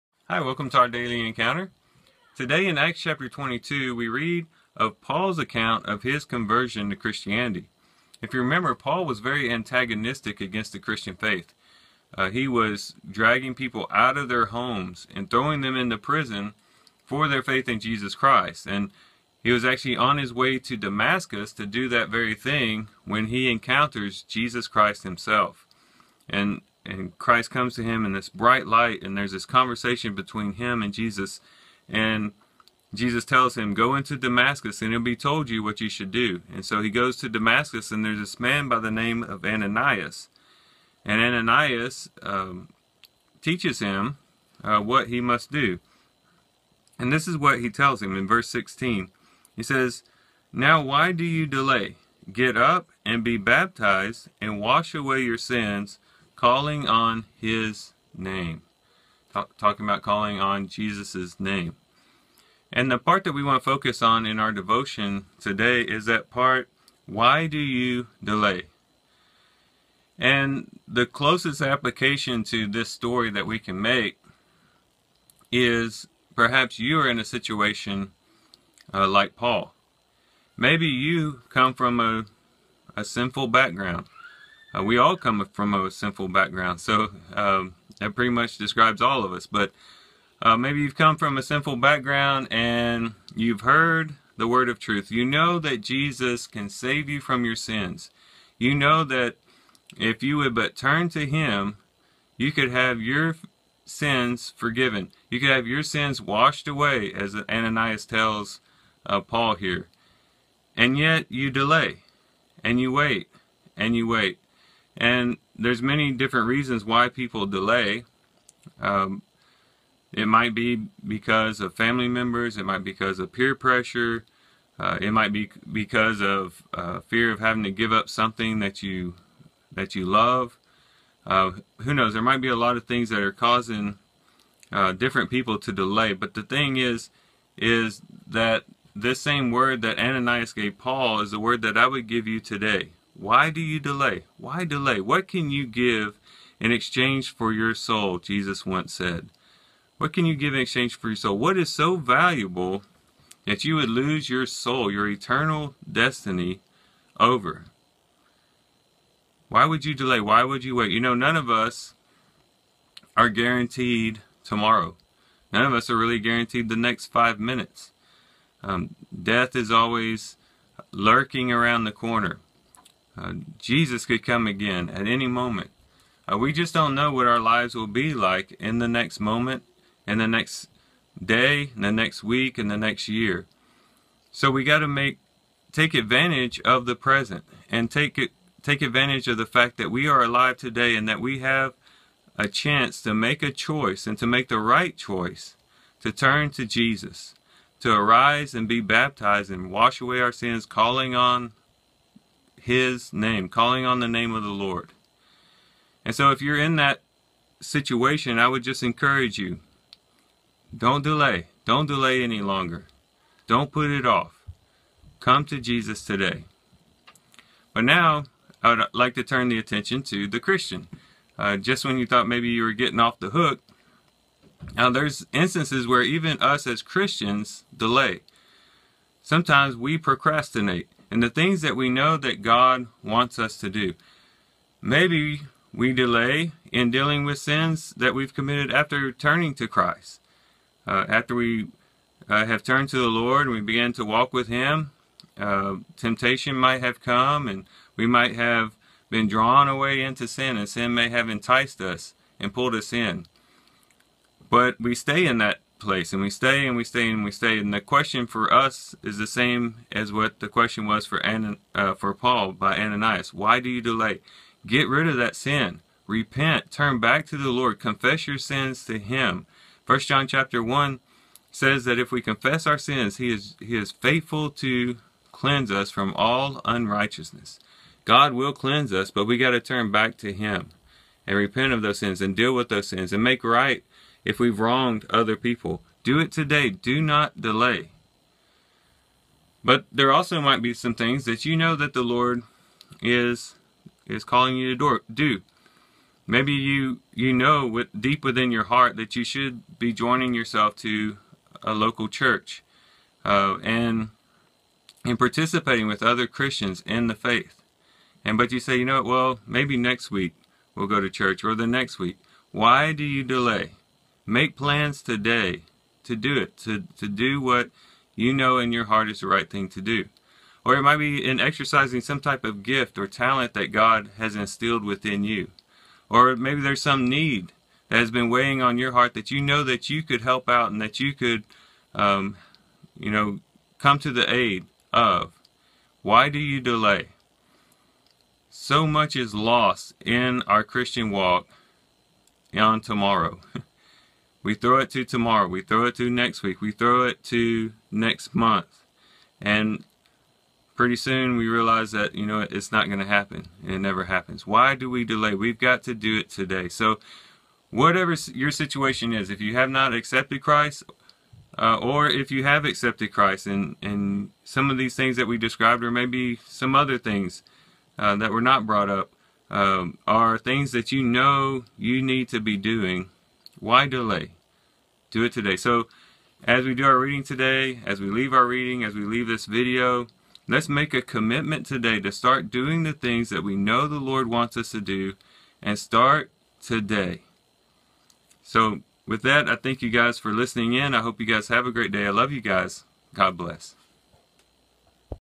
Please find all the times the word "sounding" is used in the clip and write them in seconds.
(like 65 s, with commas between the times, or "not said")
not said.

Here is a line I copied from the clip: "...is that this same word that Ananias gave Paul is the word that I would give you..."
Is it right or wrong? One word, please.
right.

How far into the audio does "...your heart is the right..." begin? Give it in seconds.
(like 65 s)
318 s.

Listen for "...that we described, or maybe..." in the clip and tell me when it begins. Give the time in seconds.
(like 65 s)
365 s.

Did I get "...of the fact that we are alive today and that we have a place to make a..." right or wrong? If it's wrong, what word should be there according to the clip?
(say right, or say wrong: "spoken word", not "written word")
wrong: "chance", not "place".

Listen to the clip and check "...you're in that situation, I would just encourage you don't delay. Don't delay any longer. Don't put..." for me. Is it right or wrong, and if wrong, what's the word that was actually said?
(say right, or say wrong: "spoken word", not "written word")
right.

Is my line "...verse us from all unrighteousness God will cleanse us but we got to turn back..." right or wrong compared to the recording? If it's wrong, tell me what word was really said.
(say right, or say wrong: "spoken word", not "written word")
wrong: "cleanse", not "verse".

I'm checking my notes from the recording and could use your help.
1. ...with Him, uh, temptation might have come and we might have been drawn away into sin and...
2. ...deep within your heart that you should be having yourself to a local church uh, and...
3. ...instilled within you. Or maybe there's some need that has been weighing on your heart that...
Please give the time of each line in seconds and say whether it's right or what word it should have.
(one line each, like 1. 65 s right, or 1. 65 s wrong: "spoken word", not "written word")
1. 244 s right
2. 297 s wrong: "joining", not "having"
3. 324 s right.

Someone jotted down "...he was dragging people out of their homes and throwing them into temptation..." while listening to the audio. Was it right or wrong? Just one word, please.
wrong.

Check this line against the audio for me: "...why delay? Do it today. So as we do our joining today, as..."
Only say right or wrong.
wrong.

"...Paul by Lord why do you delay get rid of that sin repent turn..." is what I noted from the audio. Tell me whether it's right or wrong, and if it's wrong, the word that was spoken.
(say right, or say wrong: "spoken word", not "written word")
wrong: "Ananias", not "Lord".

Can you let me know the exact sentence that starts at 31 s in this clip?
And Jesus tells him, Go into Damascus, and it'll be told you what you should do.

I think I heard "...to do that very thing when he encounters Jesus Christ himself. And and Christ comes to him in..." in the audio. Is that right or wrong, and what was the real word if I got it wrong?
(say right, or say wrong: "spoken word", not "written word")
right.